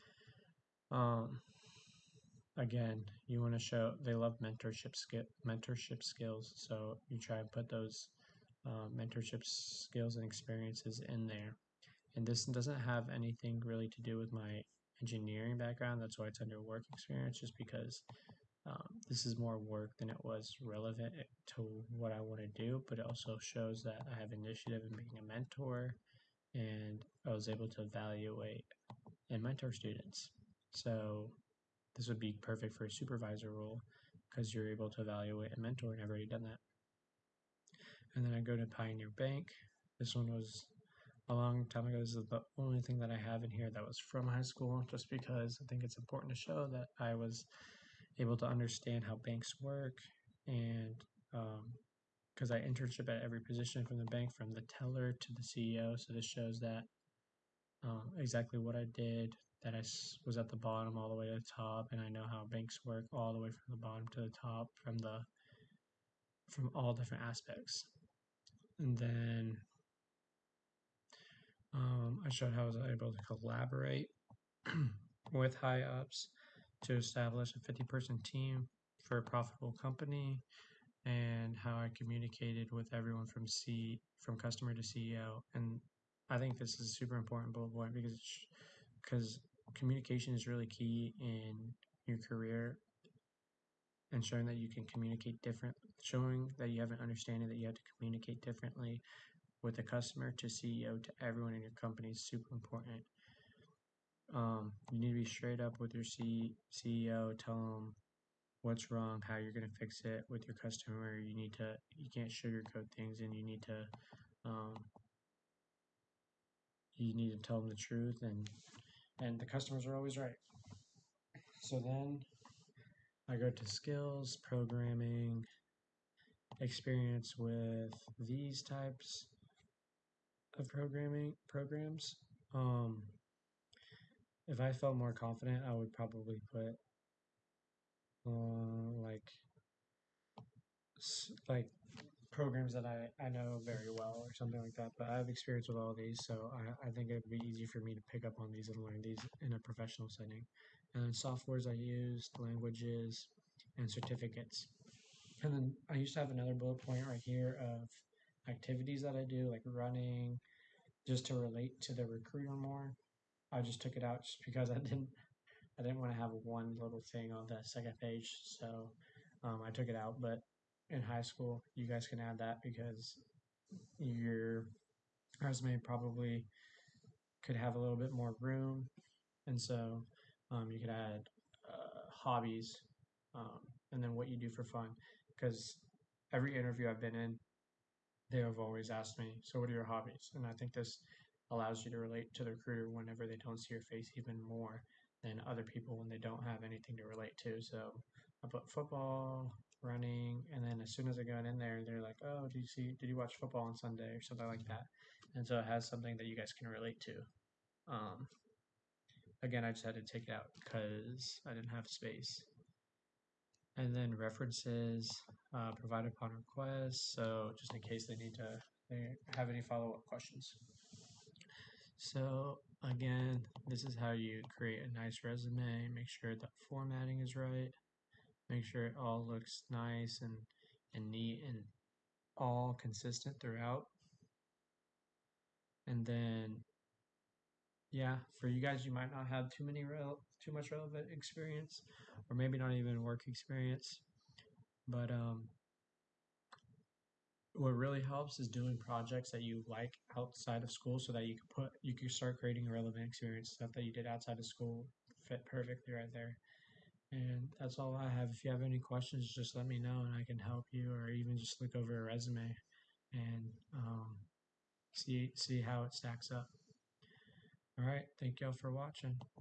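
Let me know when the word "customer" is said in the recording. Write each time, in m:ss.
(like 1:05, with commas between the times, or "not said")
1:24, 1:39, 1:50, 1:59.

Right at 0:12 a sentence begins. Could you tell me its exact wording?
And this doesn't have anything really to do with my engineering background.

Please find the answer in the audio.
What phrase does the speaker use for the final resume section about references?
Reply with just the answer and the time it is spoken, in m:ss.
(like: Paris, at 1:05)
provided upon request, at 3:35.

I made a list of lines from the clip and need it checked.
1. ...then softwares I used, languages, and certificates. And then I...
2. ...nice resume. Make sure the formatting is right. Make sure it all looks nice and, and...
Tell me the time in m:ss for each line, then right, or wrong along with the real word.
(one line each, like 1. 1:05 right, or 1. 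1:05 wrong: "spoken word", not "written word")
1. 2:31 right
2. 3:44 right.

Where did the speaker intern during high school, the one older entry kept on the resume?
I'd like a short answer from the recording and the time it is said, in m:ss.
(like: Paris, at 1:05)
Pioneer Bank, at 0:38.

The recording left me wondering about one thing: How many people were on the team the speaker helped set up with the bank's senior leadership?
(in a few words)
50 person team.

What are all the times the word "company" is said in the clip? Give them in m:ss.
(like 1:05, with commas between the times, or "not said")
1:19, 1:41.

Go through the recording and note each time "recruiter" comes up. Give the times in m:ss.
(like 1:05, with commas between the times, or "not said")
2:42, 3:12.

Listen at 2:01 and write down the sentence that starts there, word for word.
So then, I go to skills, programming, experience with these types of programming programs.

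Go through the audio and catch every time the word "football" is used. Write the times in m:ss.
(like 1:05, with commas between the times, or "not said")
3:18, 3:23.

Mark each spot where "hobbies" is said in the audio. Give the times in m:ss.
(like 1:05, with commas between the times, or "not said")
3:02, 3:09.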